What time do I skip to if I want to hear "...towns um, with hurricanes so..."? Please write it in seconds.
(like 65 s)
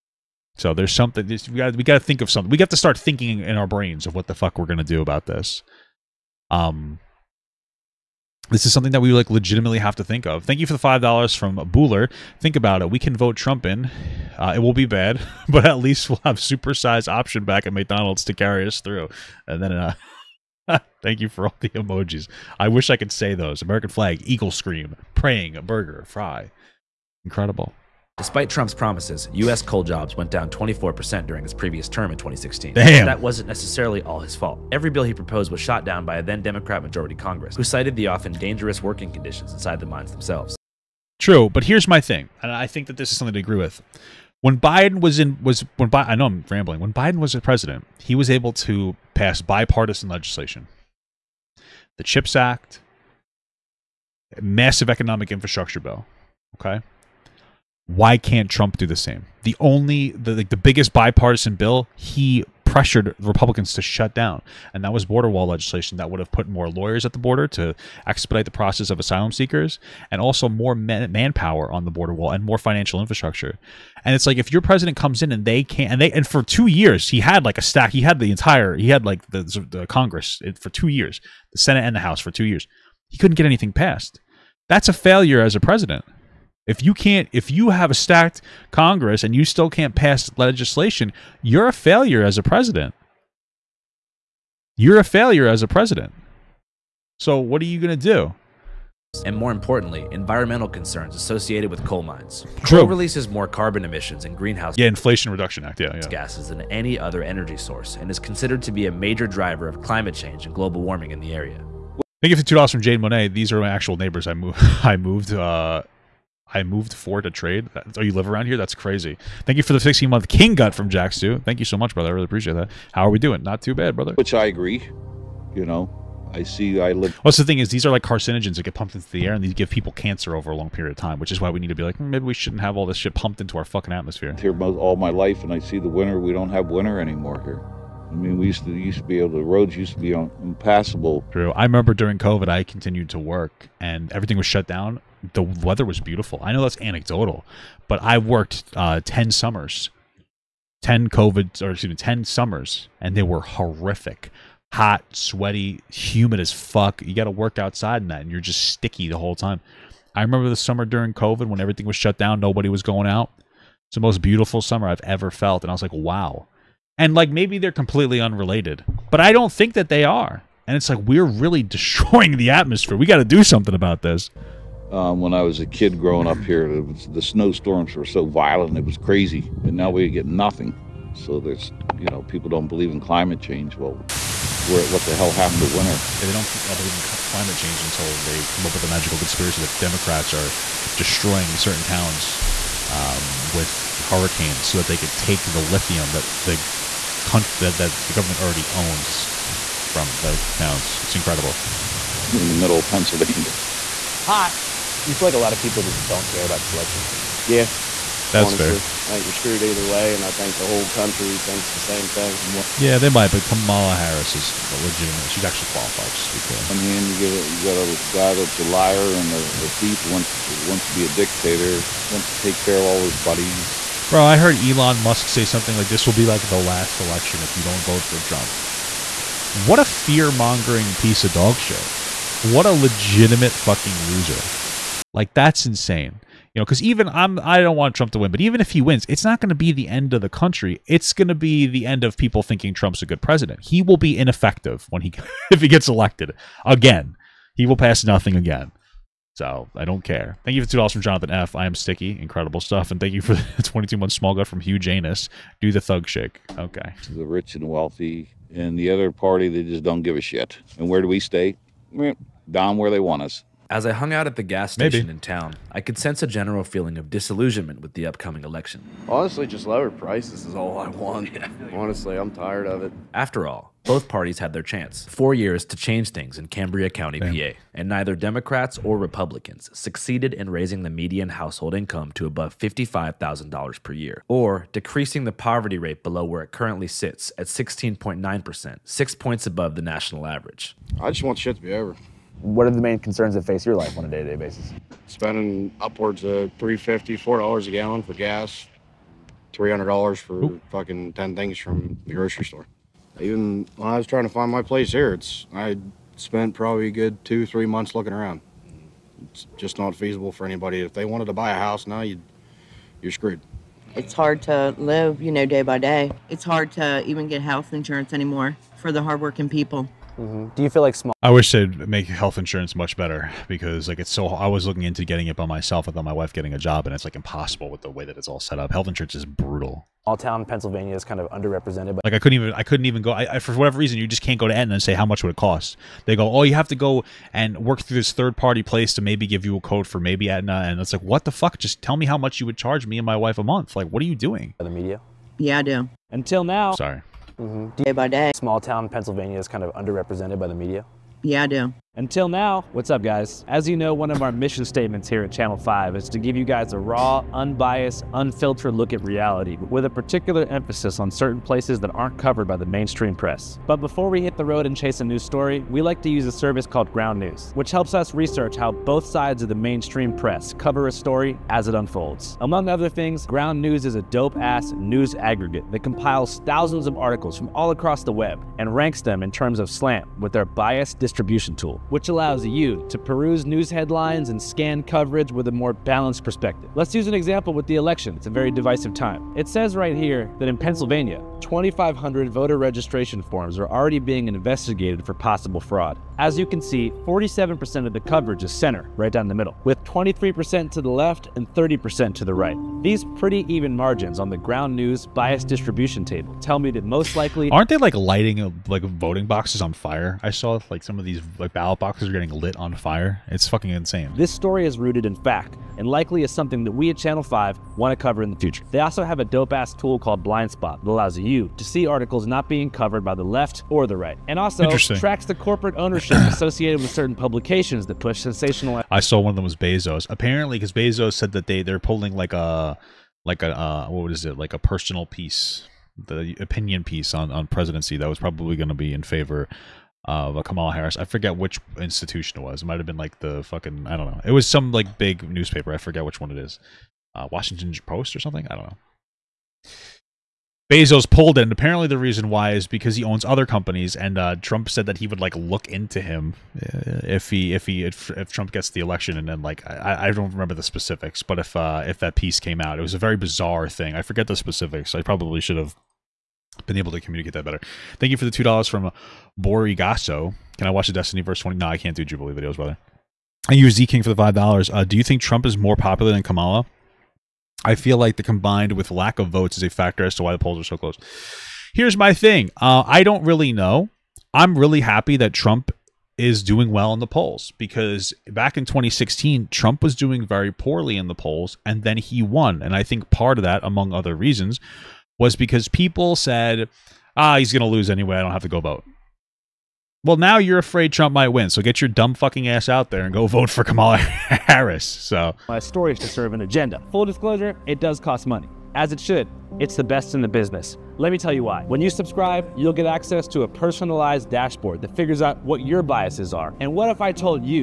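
191 s.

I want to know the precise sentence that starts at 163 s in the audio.
It's the most beautiful summer I've ever felt, and I was like, wow.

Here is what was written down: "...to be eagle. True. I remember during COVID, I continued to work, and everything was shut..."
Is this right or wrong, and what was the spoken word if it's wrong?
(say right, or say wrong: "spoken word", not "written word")
wrong: "impassable", not "eagle".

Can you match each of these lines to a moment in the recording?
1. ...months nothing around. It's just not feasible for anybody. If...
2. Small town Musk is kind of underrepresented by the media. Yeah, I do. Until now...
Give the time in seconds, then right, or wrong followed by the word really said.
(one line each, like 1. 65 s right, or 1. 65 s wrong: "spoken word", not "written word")
1. 307 s wrong: "looking", not "nothing"
2. 348 s wrong: "Pennsylvania", not "Musk".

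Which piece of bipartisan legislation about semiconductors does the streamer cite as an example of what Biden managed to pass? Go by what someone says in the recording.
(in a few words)
CHIPS Act.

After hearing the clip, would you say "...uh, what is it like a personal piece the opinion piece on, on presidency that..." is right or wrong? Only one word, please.
right.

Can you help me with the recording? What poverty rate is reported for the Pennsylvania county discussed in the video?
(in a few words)
16.9%.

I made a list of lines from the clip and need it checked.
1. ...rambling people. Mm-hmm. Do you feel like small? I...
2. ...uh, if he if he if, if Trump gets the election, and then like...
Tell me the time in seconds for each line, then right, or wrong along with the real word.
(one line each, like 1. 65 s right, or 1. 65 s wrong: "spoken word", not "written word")
1. 319 s wrong: "hardworking", not "rambling"
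2. 456 s right.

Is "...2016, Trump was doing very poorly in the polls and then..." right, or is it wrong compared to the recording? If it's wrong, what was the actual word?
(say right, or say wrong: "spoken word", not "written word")
right.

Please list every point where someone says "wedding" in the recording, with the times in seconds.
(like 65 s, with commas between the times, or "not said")
not said.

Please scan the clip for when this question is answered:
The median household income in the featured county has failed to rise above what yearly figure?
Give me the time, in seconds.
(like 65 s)
282 s.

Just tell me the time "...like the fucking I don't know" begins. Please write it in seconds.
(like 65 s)
442 s.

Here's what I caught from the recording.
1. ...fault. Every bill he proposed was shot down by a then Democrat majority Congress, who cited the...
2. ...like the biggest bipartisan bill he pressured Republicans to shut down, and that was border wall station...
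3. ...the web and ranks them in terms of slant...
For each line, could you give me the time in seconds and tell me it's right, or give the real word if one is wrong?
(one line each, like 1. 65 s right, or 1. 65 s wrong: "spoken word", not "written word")
1. 34 s right
2. 60 s wrong: "legislation", not "station"
3. 378 s right.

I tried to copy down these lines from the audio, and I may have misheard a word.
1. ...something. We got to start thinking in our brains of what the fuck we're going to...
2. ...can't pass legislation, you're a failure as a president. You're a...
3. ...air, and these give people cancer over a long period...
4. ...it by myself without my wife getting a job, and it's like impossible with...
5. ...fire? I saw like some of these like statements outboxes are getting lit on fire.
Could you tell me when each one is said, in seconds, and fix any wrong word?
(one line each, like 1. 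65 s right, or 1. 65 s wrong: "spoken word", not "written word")
1. 2 s right
2. 89 s right
3. 129 s right
4. 325 s right
5. 409 s wrong: "ballots", not "statements".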